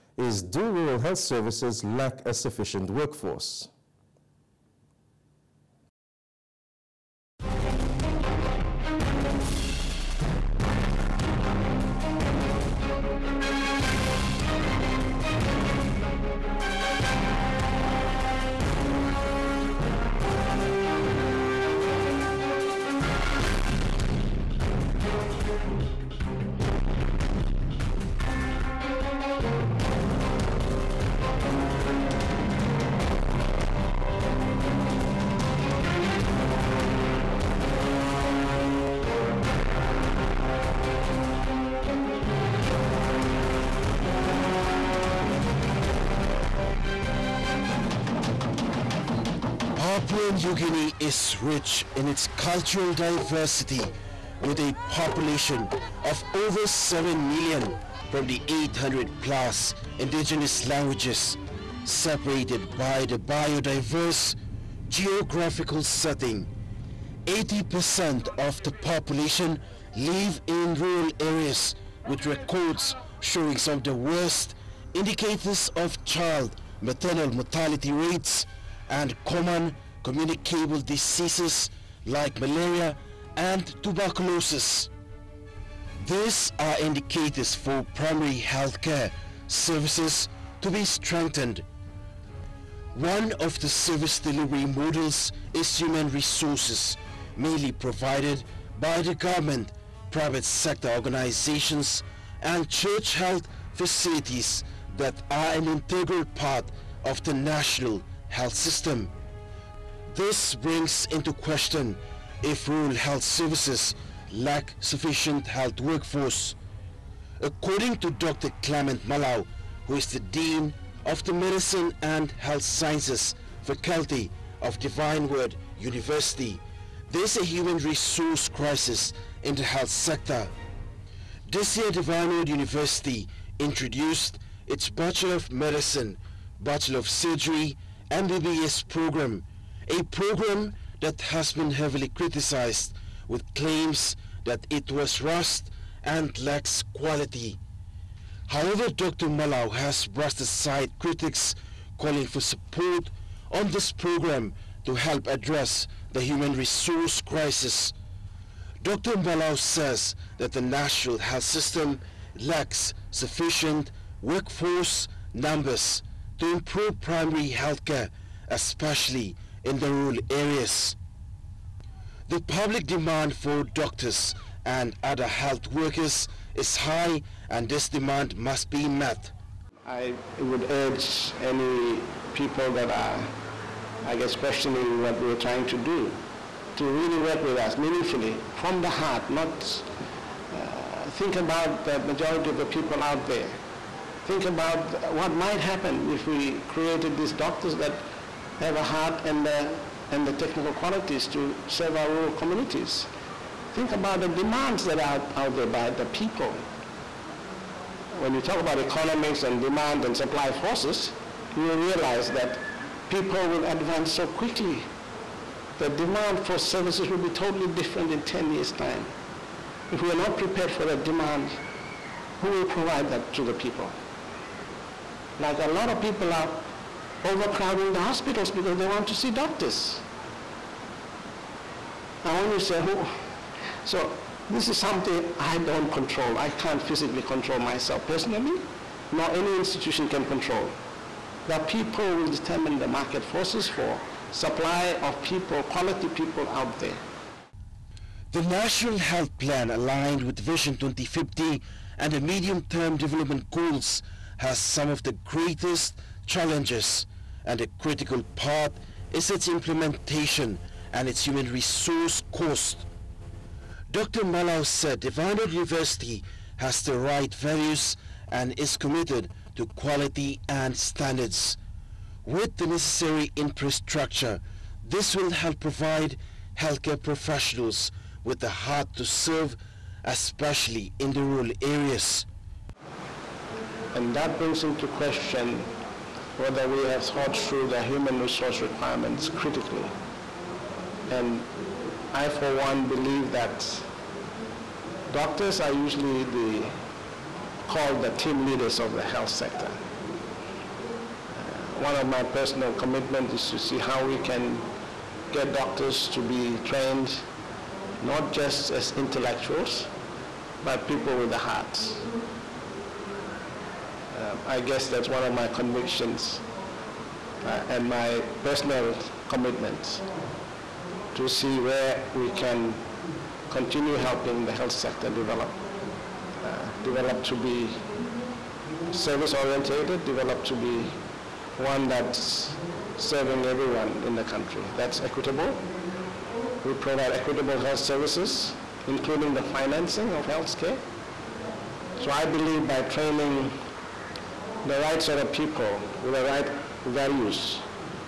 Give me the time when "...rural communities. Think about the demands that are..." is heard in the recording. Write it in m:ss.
3:22.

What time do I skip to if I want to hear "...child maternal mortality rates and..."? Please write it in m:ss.
1:16.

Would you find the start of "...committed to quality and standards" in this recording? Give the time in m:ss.
4:28.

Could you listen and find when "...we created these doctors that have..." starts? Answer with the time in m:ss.
3:16.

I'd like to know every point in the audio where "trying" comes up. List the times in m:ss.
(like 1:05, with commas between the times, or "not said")
3:05.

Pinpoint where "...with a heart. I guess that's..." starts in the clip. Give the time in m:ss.
5:11.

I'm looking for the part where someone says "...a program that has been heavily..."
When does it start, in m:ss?
2:19.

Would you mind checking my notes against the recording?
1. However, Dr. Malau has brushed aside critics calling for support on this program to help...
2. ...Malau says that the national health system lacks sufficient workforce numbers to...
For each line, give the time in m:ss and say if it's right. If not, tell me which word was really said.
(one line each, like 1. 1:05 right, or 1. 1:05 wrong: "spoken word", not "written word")
1. 2:28 right
2. 2:39 right.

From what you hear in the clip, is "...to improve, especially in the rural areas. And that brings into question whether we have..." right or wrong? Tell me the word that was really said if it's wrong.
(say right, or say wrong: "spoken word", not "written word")
wrong: "serve", not "improve".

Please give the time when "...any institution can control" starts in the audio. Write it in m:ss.
3:59.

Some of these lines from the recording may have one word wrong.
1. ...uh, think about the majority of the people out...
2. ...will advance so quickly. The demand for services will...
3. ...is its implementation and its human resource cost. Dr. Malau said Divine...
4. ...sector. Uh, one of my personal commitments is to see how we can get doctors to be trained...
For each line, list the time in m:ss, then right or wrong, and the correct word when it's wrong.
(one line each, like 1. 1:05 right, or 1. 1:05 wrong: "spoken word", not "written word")
1. 3:10 right
2. 3:33 right
3. 4:19 right
4. 4:59 right.